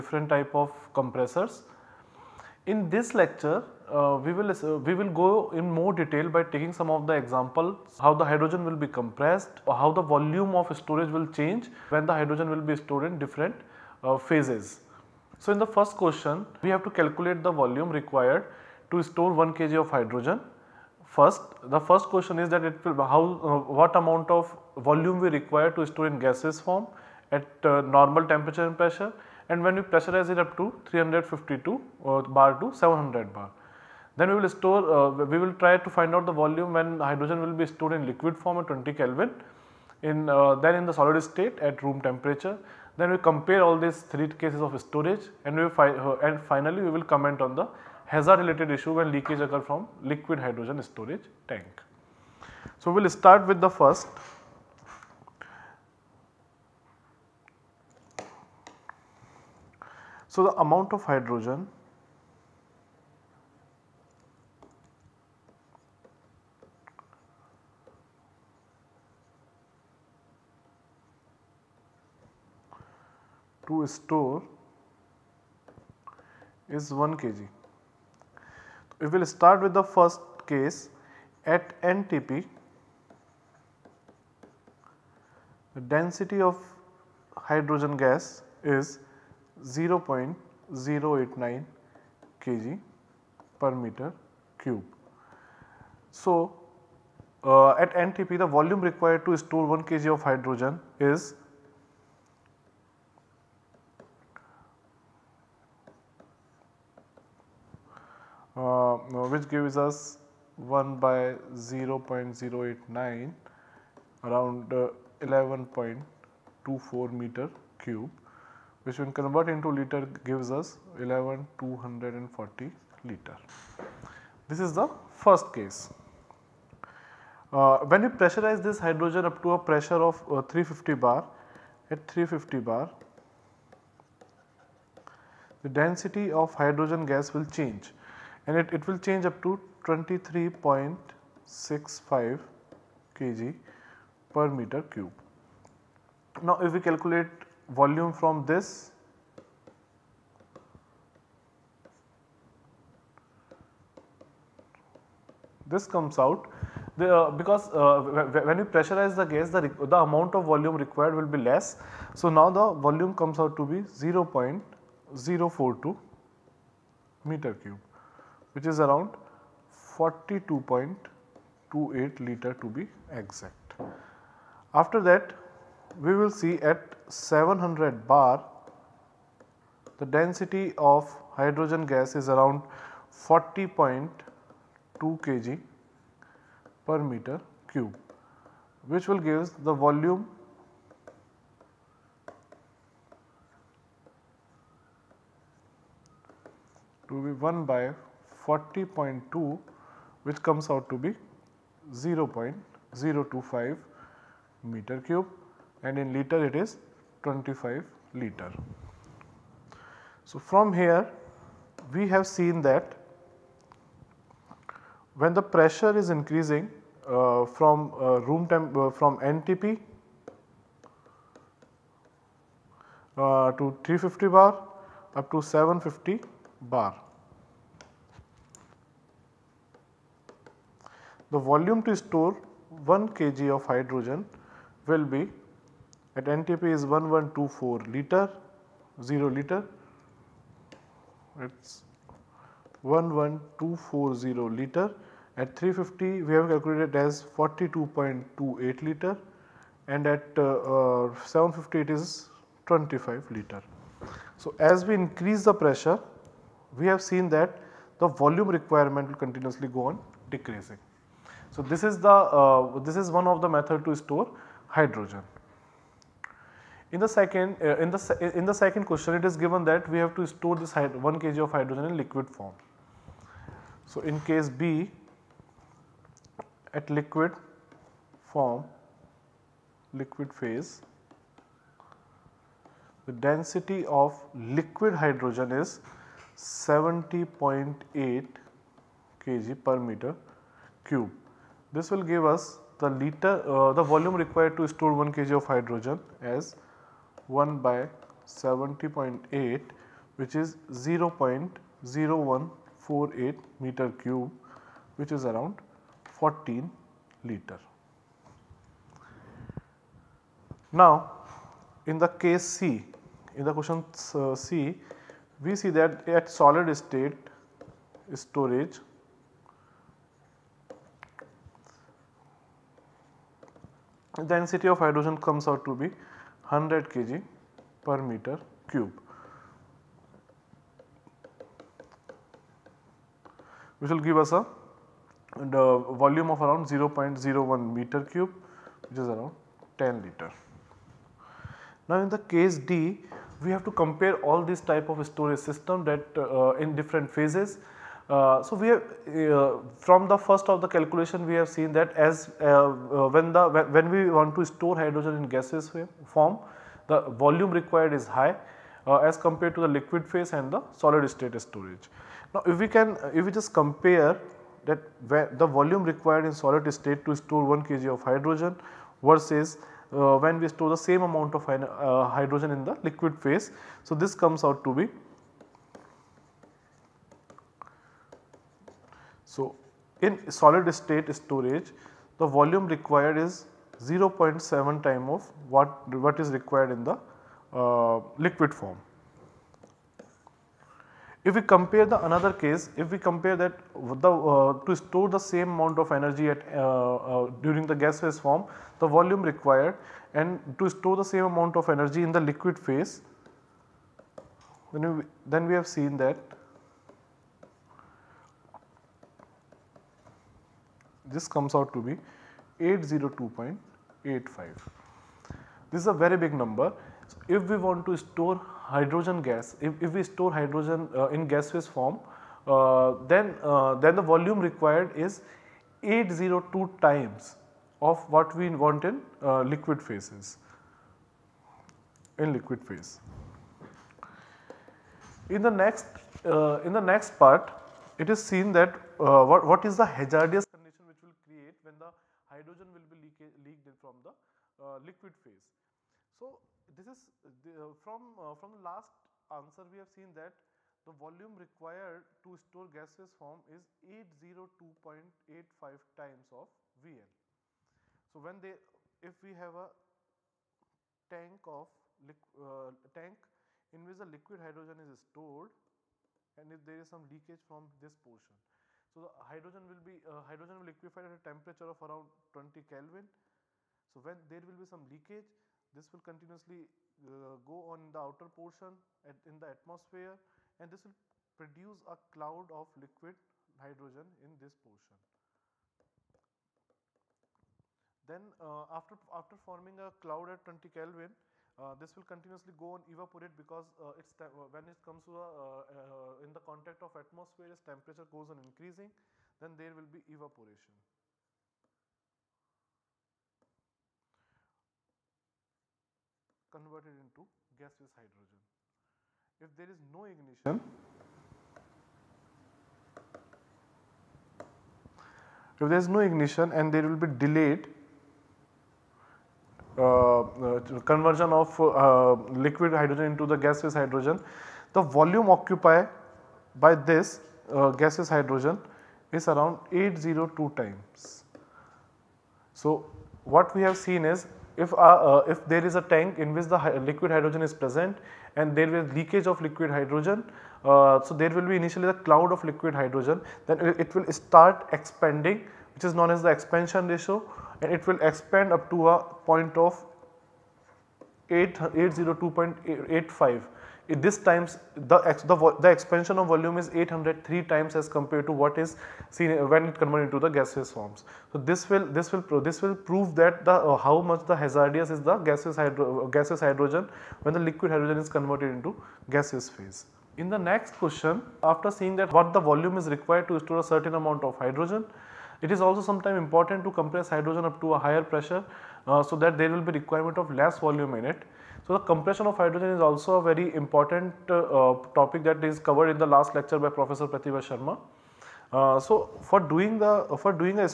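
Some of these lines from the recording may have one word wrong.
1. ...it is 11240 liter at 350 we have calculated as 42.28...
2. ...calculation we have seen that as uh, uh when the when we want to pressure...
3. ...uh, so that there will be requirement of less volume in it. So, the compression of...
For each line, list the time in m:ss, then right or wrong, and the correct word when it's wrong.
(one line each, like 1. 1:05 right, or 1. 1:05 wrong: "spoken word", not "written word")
1. 4:01 right
2. 5:50 wrong: "store", not "pressure"
3. 9:38 right.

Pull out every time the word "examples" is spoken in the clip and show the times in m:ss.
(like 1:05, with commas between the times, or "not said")
0:07.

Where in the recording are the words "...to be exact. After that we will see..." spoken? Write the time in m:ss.
2:52.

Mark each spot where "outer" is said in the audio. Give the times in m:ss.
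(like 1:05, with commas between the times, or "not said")
7:57.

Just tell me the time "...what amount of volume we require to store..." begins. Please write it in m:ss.
0:23.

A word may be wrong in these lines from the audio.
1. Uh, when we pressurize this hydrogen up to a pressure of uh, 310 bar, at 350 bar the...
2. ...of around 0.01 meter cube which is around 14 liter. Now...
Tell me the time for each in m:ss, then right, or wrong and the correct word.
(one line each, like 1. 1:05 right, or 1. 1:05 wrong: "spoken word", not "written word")
1. 2:07 wrong: "350", not "310"
2. 5:36 wrong: "10", not "14".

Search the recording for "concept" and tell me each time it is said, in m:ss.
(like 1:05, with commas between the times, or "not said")
not said.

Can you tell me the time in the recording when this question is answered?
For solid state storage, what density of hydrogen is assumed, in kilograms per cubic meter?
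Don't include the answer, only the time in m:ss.
5:25.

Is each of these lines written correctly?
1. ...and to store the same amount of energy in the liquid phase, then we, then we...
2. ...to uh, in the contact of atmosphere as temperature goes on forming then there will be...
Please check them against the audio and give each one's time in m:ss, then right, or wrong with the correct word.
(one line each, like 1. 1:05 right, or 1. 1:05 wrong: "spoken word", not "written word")
1. 6:40 right
2. 8:15 wrong: "increasing", not "forming".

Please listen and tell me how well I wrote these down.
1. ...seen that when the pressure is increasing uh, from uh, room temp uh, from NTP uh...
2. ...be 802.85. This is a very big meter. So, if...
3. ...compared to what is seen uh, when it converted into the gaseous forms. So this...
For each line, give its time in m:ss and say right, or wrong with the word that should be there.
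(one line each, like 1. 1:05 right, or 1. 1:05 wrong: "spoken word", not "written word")
1. 3:32 right
2. 6:51 wrong: "number", not "meter"
3. 9:17 right.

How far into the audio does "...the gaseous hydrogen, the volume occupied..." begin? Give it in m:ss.
8:43.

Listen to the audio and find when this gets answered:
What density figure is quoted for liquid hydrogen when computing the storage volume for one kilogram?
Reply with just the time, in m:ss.
4:46.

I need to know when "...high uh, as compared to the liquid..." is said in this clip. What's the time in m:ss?
5:58.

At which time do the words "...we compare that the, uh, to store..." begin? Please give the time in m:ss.
6:32.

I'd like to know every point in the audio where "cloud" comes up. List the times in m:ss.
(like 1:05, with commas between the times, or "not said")
8:02, 8:09, 9:01.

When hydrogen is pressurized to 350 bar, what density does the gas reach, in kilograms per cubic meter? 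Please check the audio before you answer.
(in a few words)
23.65.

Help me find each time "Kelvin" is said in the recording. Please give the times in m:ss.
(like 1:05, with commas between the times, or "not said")
0:38, 7:52, 8:10.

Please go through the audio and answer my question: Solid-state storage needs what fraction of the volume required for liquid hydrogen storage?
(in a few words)
0.7 times.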